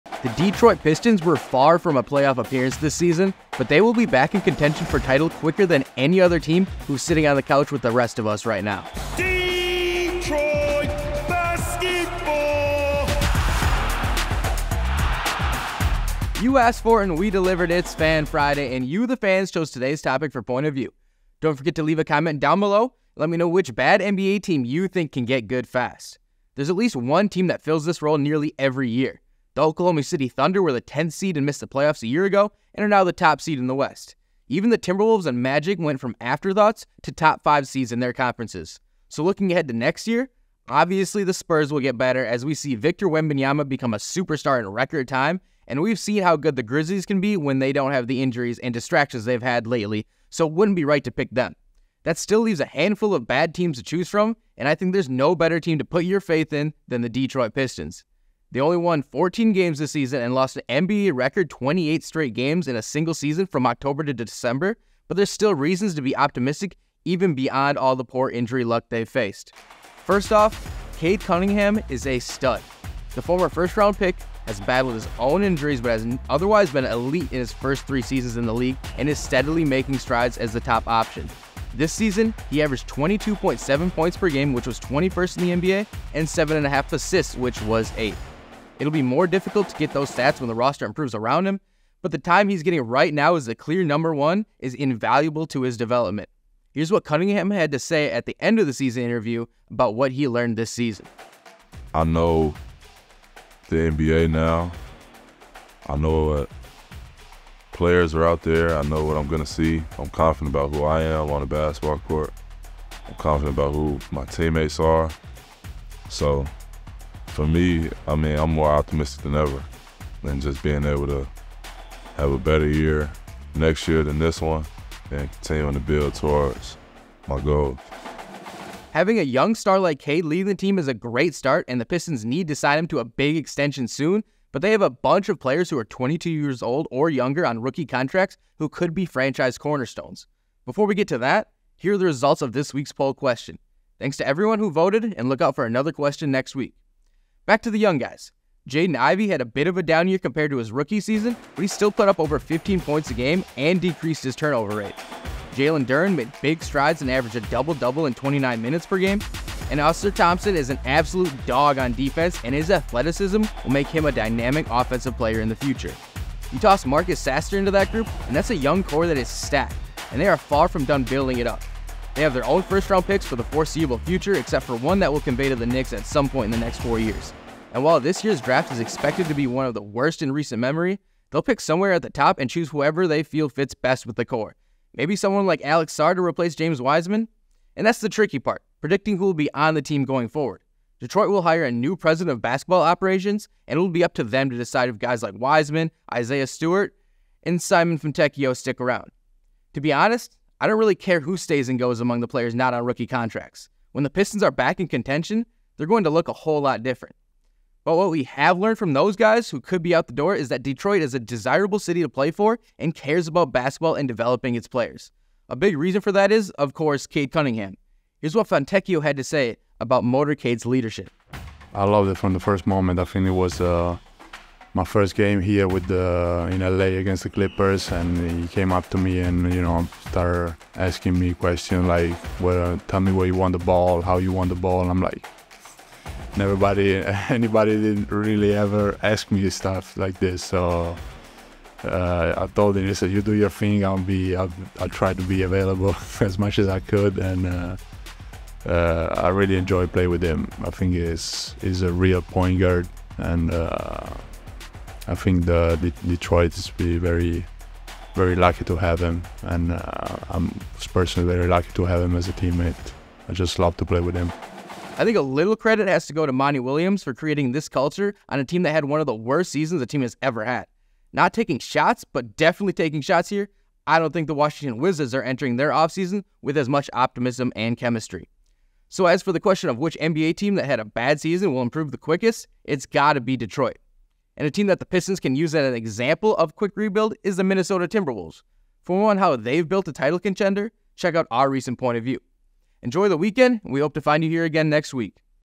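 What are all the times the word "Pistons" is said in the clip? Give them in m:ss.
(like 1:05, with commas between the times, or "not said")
0:00, 0:57, 2:11, 3:24, 4:44.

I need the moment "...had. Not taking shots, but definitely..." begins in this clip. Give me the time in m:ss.
4:30.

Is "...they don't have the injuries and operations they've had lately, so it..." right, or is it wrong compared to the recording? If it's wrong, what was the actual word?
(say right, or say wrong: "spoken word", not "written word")
wrong: "distractions", not "operations".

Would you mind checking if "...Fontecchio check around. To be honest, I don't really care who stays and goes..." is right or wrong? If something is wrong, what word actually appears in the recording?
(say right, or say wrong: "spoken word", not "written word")
wrong: "stick", not "check".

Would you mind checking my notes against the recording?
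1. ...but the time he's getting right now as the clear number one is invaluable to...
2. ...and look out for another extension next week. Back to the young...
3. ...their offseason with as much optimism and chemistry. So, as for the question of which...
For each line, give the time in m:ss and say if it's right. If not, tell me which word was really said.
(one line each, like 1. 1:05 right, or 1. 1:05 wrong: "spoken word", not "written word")
1. 1:32 right
2. 2:25 wrong: "question", not "extension"
3. 4:35 right.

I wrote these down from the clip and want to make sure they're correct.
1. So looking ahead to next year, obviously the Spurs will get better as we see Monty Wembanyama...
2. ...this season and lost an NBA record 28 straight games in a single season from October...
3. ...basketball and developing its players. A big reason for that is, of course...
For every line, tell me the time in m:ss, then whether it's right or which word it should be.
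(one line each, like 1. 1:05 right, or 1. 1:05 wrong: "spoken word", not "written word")
1. 0:39 wrong: "Victor", not "Monty"
2. 0:59 right
3. 3:33 right.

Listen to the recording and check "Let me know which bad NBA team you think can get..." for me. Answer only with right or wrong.
right.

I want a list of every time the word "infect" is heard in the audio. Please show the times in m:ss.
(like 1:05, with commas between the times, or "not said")
not said.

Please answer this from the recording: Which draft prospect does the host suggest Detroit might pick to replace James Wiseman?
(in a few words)
Alex Sarr.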